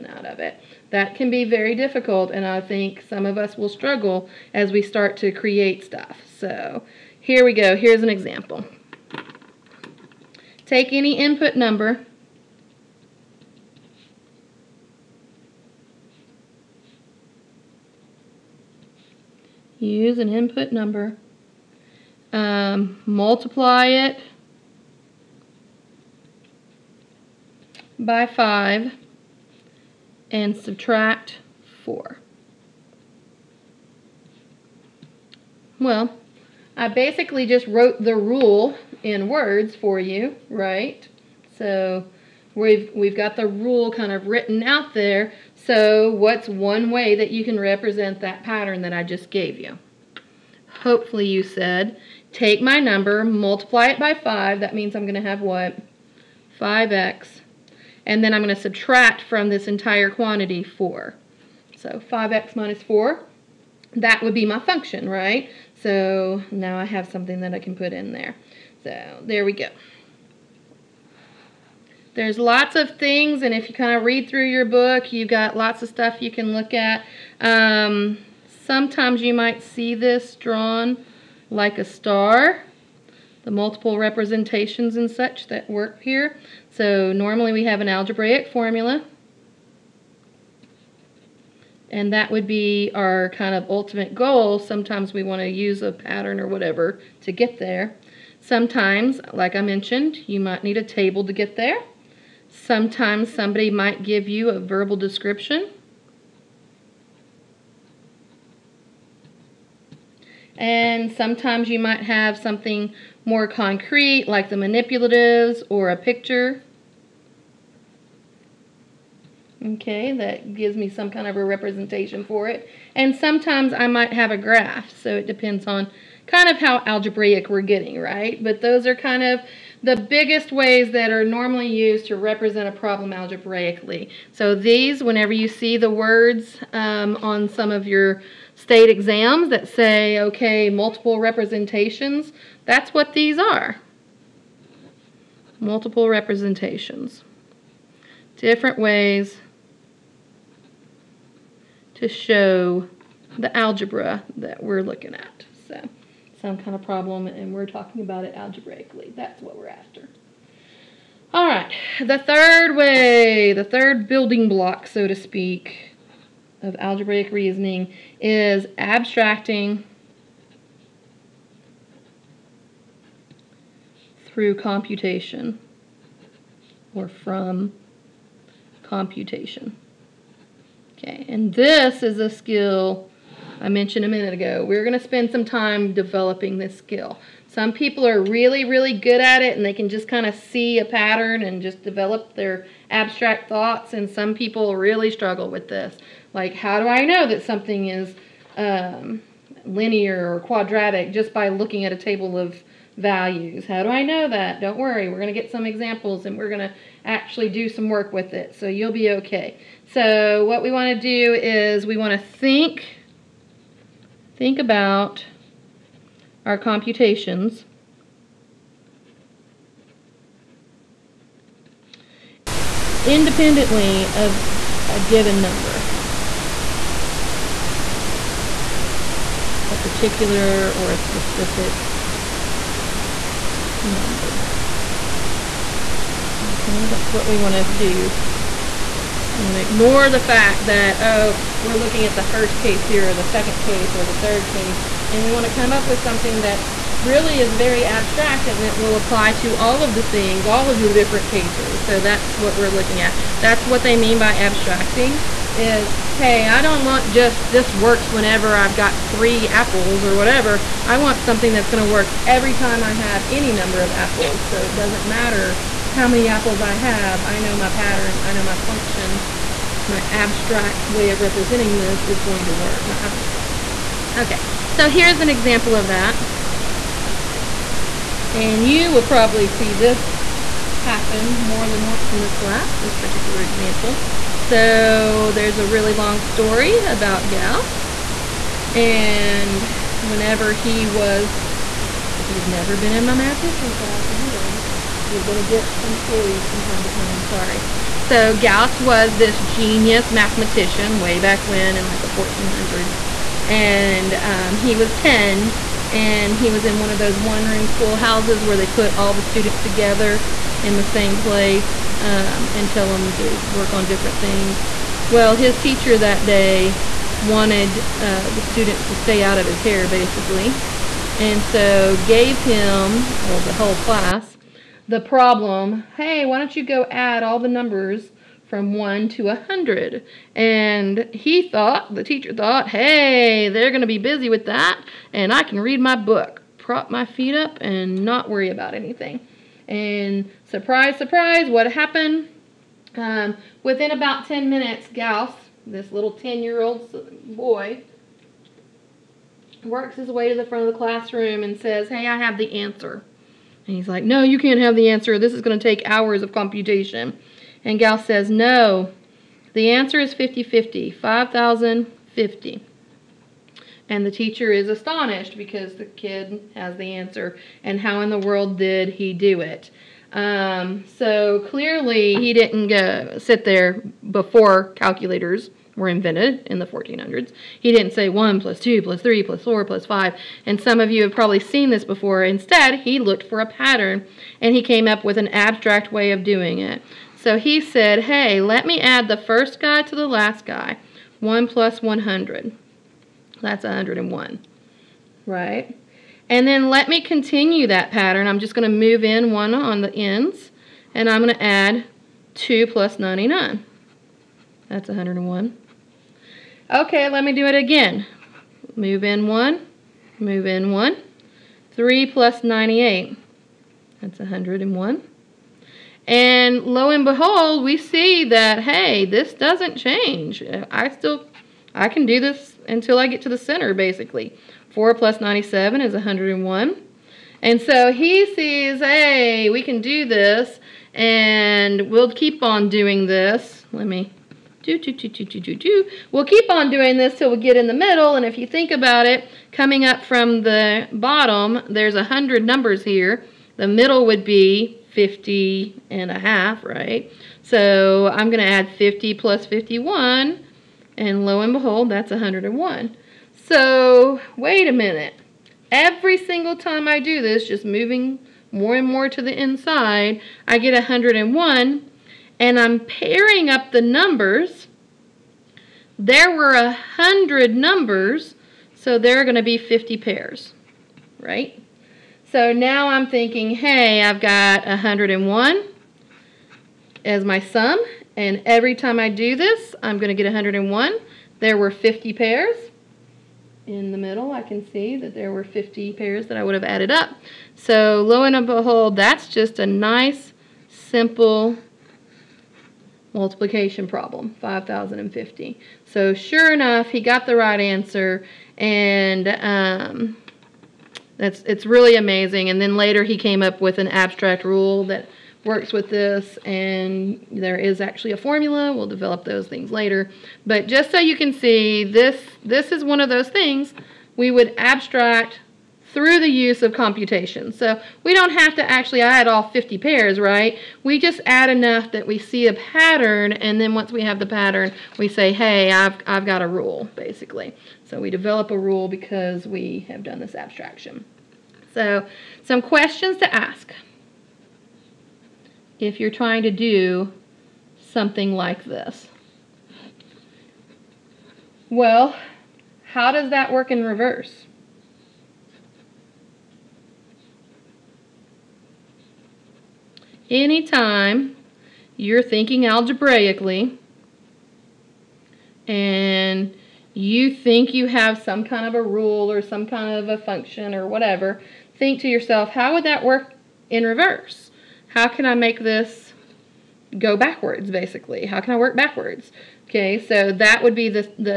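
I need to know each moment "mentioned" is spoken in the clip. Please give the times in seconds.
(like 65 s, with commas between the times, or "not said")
99 s, 183 s.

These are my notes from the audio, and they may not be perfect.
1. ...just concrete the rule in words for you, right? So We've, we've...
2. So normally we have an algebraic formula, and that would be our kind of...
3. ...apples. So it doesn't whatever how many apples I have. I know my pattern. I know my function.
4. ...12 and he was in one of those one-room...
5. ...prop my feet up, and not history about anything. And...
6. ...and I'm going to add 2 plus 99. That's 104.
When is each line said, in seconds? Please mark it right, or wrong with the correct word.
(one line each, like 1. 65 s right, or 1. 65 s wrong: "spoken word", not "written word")
1. 37 s wrong: "wrote", not "concrete"
2. 86 s right
3. 263 s wrong: "matter", not "whatever"
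4. 304 s wrong: "10", not "12"
5. 336 s wrong: "worry", not "history"
6. 400 s wrong: "101", not "104".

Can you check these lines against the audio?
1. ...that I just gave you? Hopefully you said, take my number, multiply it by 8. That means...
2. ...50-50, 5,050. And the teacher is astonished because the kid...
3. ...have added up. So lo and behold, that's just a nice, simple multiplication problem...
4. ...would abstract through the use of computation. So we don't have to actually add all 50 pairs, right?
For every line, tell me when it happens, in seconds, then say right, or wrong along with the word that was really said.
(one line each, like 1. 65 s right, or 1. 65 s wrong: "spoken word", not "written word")
1. 48 s wrong: "5", not "8"
2. 360 s right
3. 486 s right
4. 514 s right.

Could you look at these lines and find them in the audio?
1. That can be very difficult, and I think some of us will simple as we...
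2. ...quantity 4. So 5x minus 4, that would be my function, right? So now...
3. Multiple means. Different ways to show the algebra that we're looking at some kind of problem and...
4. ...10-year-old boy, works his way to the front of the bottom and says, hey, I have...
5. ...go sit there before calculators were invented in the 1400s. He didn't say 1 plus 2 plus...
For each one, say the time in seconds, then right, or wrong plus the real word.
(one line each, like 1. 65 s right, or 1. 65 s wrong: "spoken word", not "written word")
1. 0 s wrong: "struggle", not "simple"
2. 60 s right
3. 145 s wrong: "representations", not "means"
4. 346 s wrong: "classroom", not "bottom"
5. 372 s right.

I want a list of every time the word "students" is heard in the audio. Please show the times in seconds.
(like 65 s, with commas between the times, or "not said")
309 s, 318 s.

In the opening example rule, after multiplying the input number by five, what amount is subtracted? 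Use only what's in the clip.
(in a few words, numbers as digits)
4.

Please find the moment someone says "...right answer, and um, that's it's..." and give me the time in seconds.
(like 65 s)
497 s.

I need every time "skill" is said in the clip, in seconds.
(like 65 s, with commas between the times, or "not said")
182 s, 186 s.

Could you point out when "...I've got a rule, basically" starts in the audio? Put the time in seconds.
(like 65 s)
526 s.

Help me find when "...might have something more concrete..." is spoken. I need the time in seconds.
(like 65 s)
111 s.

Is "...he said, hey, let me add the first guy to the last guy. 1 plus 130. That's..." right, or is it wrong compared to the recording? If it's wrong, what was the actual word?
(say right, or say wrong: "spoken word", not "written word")
wrong: "100", not "130".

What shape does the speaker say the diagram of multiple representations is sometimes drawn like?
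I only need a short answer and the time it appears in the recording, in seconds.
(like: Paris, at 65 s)
a star, at 81 s.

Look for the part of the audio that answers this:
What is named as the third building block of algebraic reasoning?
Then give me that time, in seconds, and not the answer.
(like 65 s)
168 s.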